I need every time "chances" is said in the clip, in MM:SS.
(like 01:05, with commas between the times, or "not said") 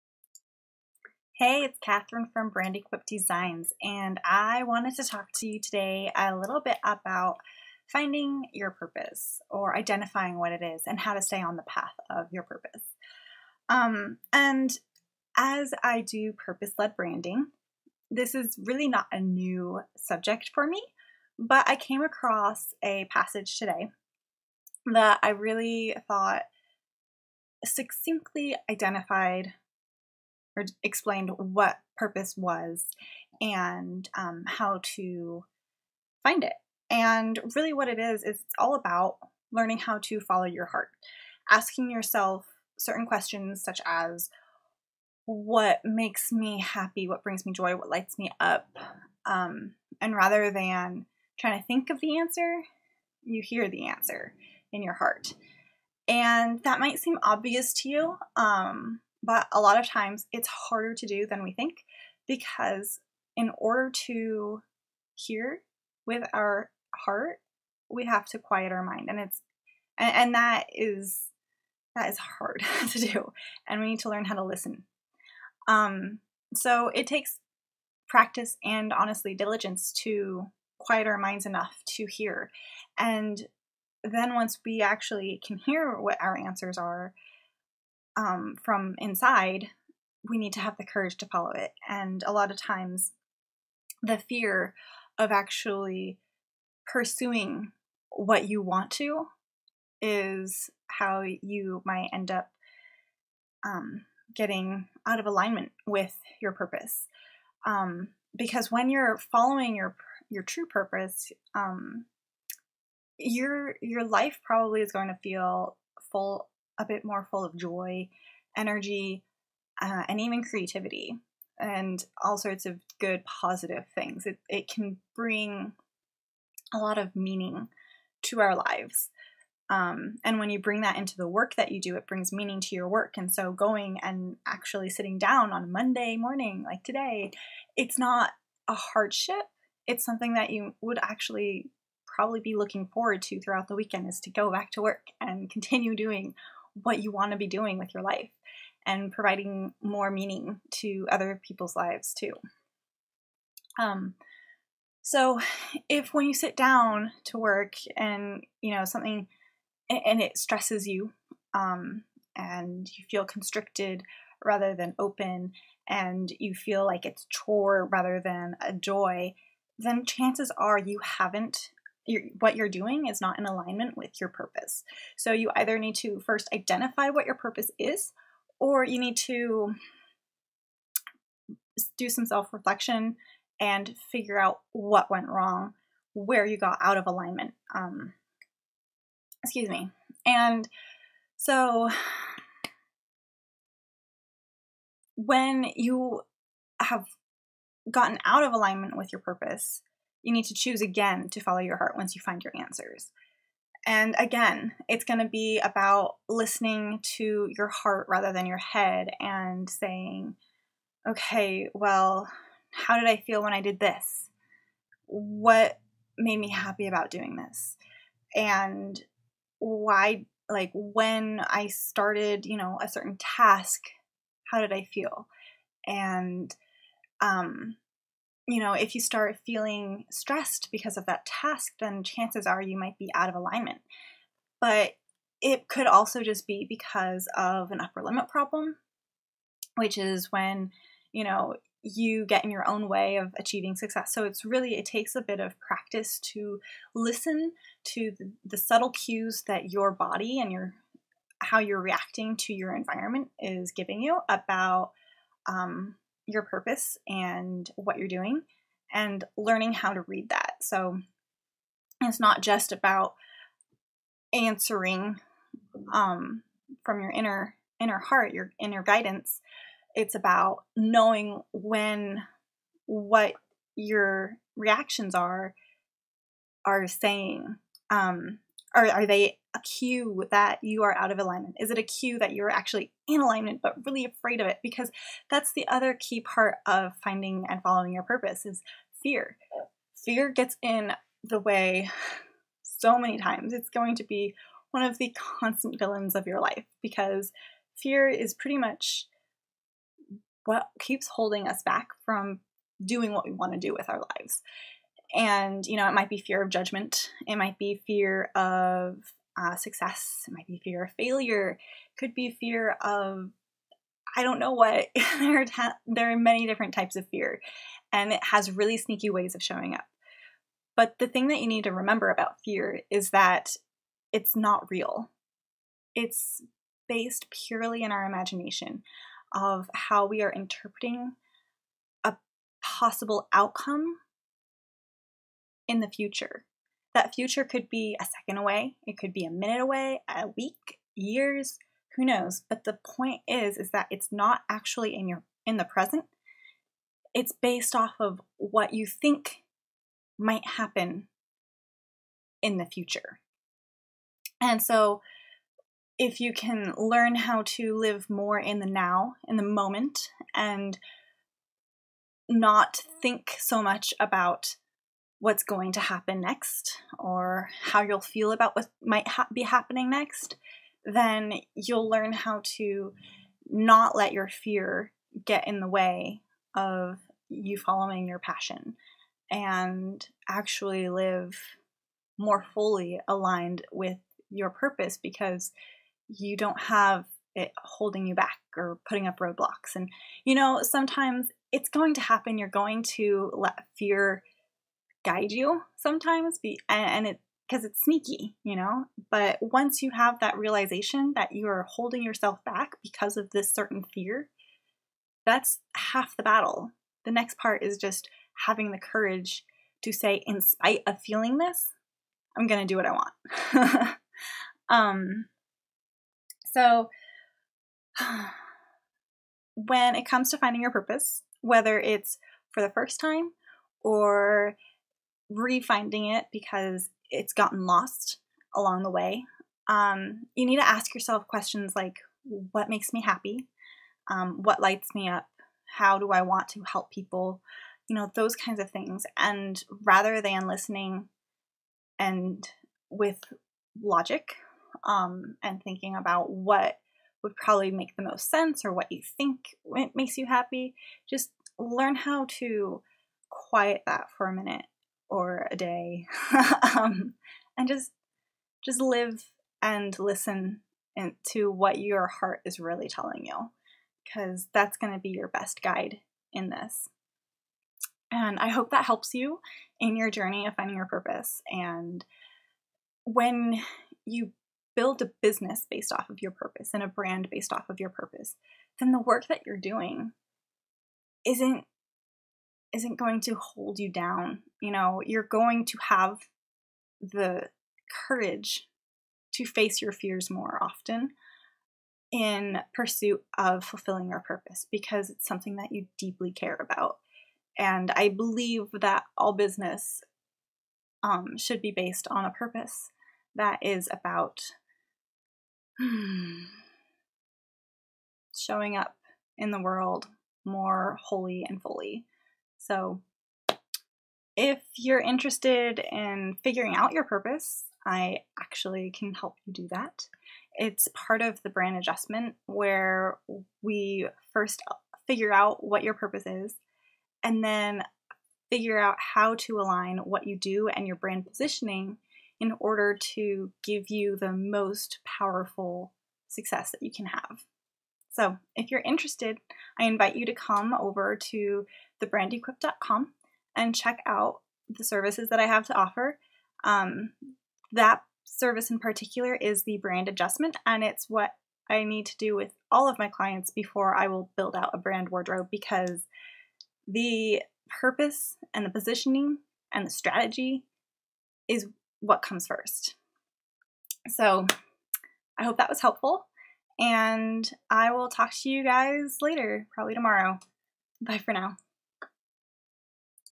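02:50, 03:52.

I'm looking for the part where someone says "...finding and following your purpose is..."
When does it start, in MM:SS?
04:47.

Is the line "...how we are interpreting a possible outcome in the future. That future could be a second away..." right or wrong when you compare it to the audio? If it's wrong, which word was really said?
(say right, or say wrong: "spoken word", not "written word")
right.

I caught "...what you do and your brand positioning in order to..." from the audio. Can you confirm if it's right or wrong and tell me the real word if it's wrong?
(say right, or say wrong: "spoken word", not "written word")
right.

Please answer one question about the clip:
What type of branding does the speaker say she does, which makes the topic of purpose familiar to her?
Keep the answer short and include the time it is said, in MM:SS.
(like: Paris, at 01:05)
Purpose led branding, at 00:16.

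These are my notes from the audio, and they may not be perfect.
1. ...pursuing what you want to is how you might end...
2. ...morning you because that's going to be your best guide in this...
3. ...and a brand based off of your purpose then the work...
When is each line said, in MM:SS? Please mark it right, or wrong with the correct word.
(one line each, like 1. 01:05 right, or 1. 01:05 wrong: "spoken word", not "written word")
1. 01:36 right
2. 07:42 wrong: "telling", not "morning"
3. 07:56 right.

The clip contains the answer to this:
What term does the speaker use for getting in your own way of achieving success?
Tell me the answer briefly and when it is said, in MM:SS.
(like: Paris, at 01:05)
Upper limit problem, at 03:57.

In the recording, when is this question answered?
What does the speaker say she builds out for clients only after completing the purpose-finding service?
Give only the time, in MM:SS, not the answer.
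09:14.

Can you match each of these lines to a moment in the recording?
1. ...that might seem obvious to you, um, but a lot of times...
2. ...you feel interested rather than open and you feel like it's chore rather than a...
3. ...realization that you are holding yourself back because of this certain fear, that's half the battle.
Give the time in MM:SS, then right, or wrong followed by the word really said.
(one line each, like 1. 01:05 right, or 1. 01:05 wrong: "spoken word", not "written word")
1. 00:56 right
2. 02:42 wrong: "constricted", not "interested"
3. 06:40 right.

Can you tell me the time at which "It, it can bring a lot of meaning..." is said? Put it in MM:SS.
02:04.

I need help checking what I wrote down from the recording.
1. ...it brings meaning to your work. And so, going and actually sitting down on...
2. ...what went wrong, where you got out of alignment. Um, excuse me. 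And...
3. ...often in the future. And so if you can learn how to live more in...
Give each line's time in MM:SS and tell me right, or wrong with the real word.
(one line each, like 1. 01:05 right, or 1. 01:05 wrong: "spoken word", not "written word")
1. 02:11 right
2. 03:04 right
3. 05:50 wrong: "happen", not "often".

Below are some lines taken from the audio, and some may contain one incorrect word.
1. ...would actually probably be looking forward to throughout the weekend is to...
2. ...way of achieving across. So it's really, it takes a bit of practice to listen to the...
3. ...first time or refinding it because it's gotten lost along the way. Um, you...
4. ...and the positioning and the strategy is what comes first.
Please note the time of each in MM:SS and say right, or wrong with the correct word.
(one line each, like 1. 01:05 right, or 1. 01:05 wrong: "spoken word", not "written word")
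1. 02:20 right
2. 04:02 wrong: "success", not "across"
3. 07:02 right
4. 09:18 right.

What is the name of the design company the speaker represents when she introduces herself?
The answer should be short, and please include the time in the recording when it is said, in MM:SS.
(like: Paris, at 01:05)
Brandequip Designs, at 00:02.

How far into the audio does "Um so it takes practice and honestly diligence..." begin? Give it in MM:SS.
01:15.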